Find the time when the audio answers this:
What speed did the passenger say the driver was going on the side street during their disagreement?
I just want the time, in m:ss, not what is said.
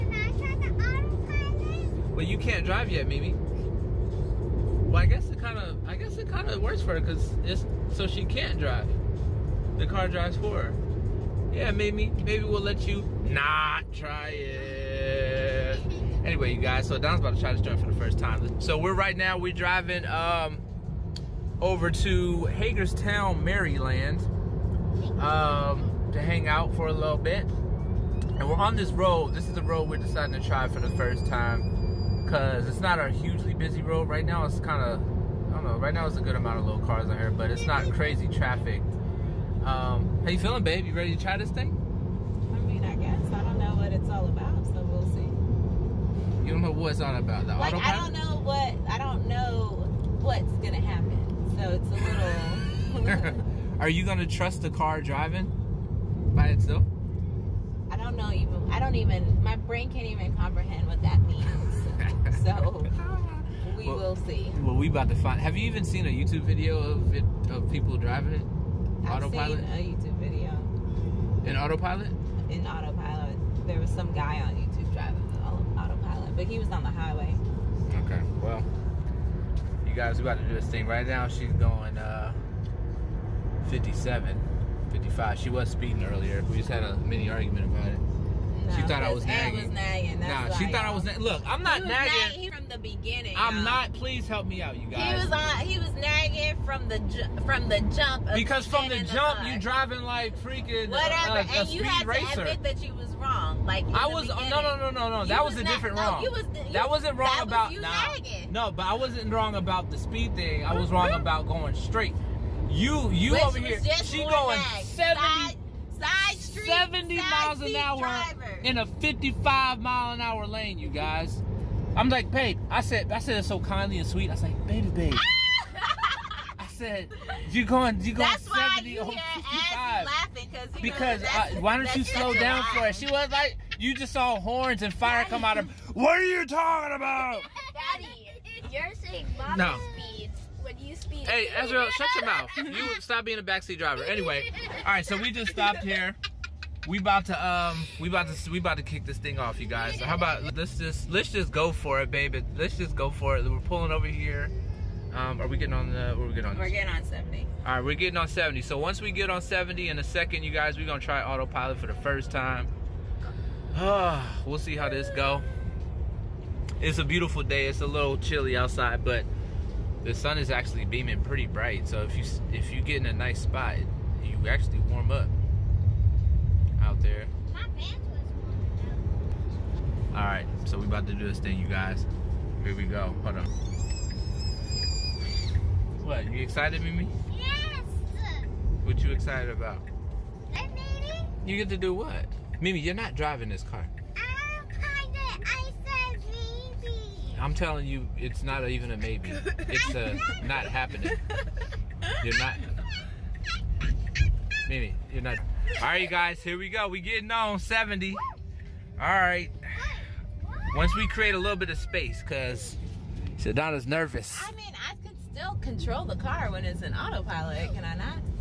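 1:56.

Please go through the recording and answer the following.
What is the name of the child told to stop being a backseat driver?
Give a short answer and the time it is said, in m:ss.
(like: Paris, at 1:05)
Ezra, at 2:21.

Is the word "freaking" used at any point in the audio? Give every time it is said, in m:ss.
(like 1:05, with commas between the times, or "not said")
1:40.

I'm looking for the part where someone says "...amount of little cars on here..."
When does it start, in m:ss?
0:36.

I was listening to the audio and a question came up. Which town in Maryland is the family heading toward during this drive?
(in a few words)
Hagerstown.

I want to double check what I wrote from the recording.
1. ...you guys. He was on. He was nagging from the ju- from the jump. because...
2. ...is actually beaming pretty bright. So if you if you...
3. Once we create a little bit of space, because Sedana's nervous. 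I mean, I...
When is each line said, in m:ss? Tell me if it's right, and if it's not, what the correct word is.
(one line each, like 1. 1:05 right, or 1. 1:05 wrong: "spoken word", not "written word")
1. 1:34 right
2. 2:50 right
3. 3:30 right.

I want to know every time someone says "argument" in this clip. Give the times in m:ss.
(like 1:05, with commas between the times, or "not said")
1:27.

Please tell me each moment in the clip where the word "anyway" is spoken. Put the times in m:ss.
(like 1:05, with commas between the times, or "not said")
0:16, 2:24.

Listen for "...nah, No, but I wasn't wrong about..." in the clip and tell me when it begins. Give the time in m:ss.
1:47.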